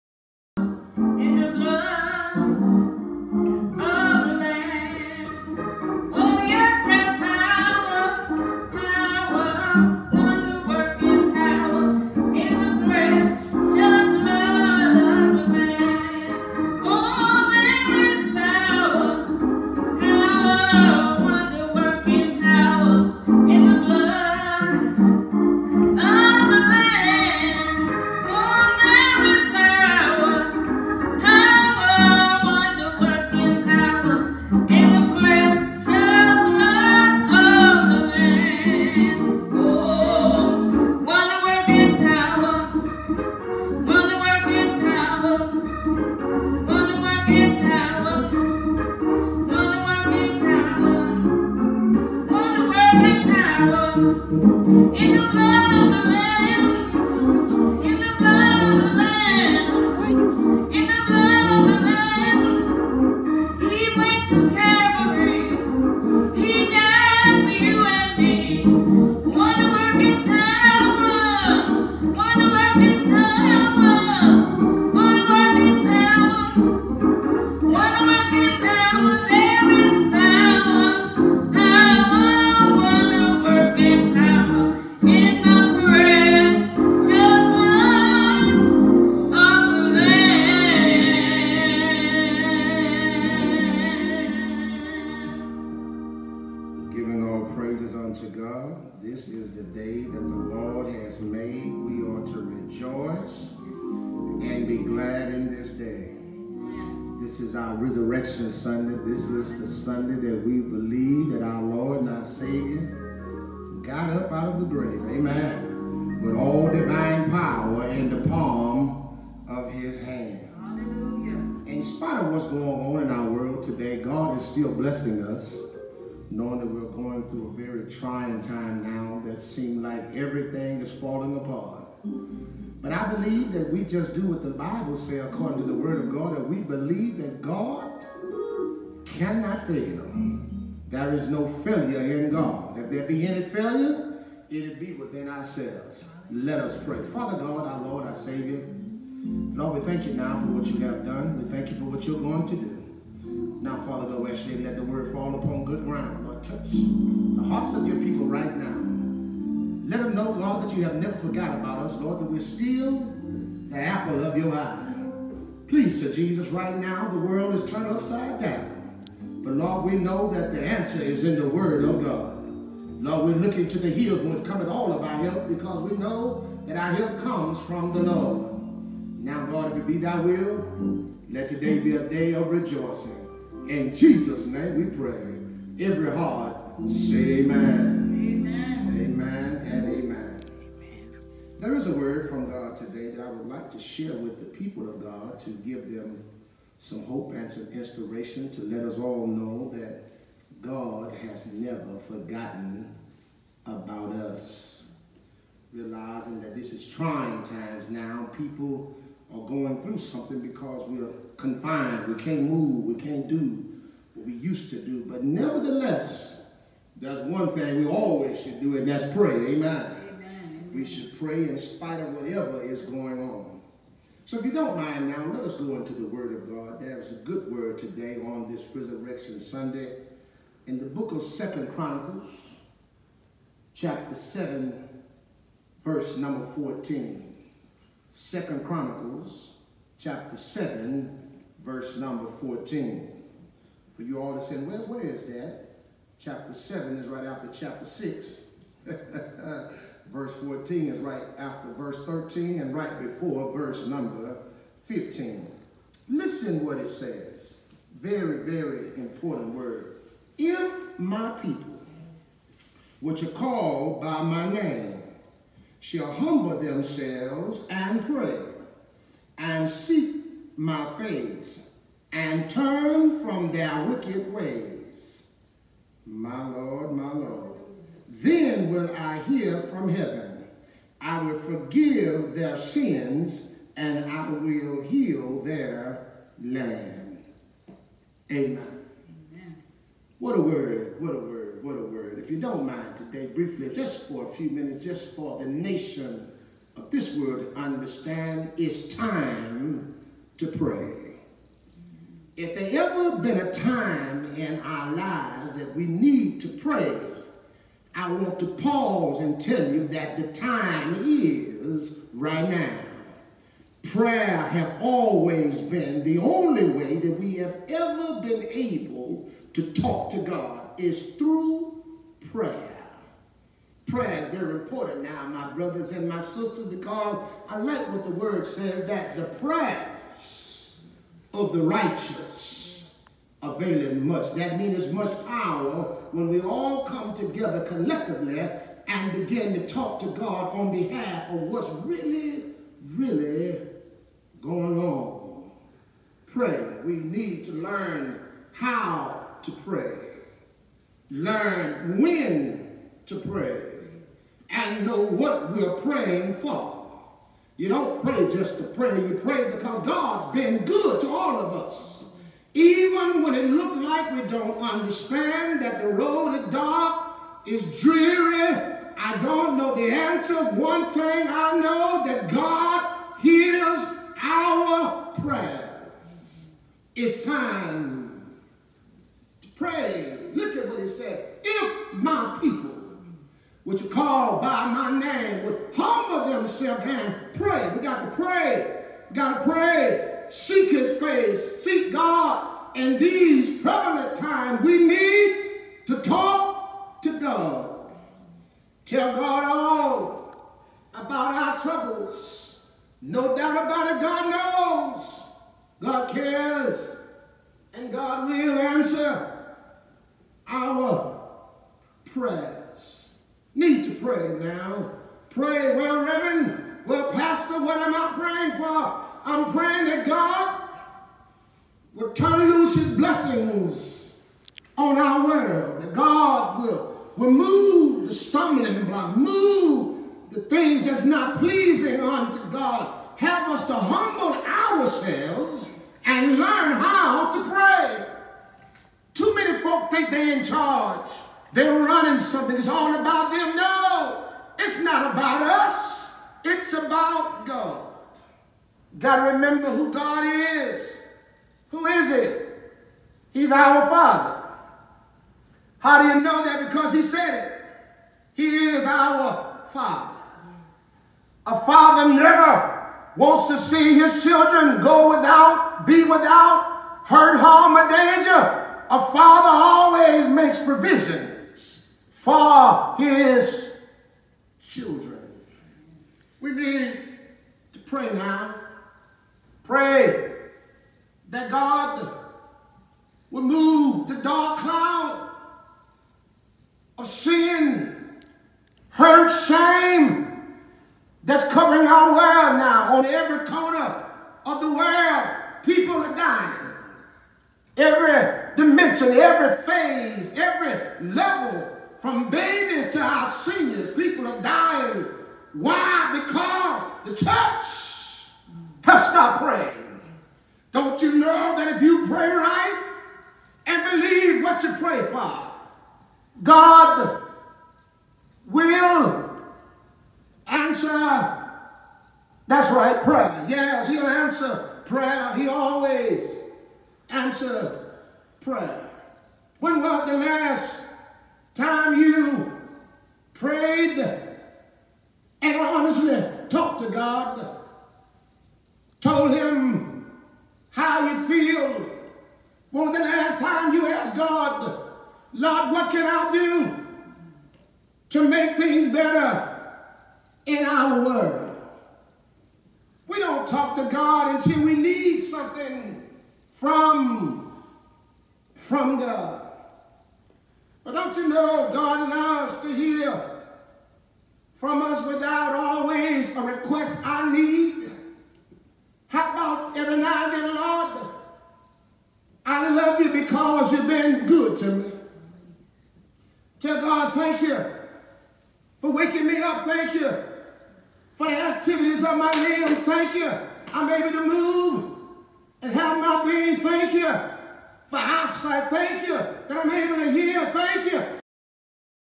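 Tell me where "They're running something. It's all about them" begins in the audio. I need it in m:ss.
7:21.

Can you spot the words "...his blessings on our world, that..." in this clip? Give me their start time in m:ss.
7:02.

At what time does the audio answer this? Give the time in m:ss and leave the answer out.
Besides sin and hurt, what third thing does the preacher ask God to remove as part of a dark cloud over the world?
8:09.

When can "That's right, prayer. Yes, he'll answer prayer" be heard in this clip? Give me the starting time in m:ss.
8:42.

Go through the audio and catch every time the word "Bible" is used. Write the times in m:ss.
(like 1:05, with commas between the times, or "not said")
2:14.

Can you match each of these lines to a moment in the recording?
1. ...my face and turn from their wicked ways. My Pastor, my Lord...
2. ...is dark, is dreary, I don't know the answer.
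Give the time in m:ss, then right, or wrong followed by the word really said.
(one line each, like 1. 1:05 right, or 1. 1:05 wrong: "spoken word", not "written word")
1. 4:30 wrong: "Lord", not "Pastor"
2. 6:06 right.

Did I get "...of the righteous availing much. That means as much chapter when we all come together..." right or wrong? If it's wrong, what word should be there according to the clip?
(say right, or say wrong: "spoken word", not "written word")
wrong: "power", not "chapter".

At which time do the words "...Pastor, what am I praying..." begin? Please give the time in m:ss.
6:57.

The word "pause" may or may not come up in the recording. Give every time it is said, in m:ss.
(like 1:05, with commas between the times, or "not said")
5:08.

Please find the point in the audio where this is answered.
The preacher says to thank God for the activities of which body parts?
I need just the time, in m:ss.
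9:42.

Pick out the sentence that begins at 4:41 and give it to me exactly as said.
I will forgive their sins and I will heal their land.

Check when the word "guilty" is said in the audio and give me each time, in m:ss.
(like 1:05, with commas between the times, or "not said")
not said.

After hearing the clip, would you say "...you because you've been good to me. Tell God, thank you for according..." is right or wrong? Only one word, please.
wrong.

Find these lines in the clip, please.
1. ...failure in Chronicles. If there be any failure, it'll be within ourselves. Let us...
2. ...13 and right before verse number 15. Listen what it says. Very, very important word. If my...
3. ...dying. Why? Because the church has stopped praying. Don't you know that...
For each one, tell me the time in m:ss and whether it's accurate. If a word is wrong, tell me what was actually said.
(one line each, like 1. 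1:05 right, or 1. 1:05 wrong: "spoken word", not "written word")
1. 2:21 wrong: "God", not "Chronicles"
2. 4:12 right
3. 8:24 right.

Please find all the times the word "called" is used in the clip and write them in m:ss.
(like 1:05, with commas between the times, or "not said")
4:23, 6:23.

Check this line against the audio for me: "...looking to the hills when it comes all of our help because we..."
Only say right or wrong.
right.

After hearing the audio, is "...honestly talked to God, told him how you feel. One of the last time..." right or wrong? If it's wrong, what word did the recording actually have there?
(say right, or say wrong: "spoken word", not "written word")
right.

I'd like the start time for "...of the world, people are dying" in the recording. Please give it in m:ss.
8:14.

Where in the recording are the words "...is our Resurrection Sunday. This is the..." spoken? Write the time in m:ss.
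1:47.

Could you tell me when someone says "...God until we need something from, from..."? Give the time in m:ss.
9:13.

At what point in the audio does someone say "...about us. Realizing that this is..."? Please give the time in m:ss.
3:23.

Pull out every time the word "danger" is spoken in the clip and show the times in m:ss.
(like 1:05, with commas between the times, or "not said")
7:47.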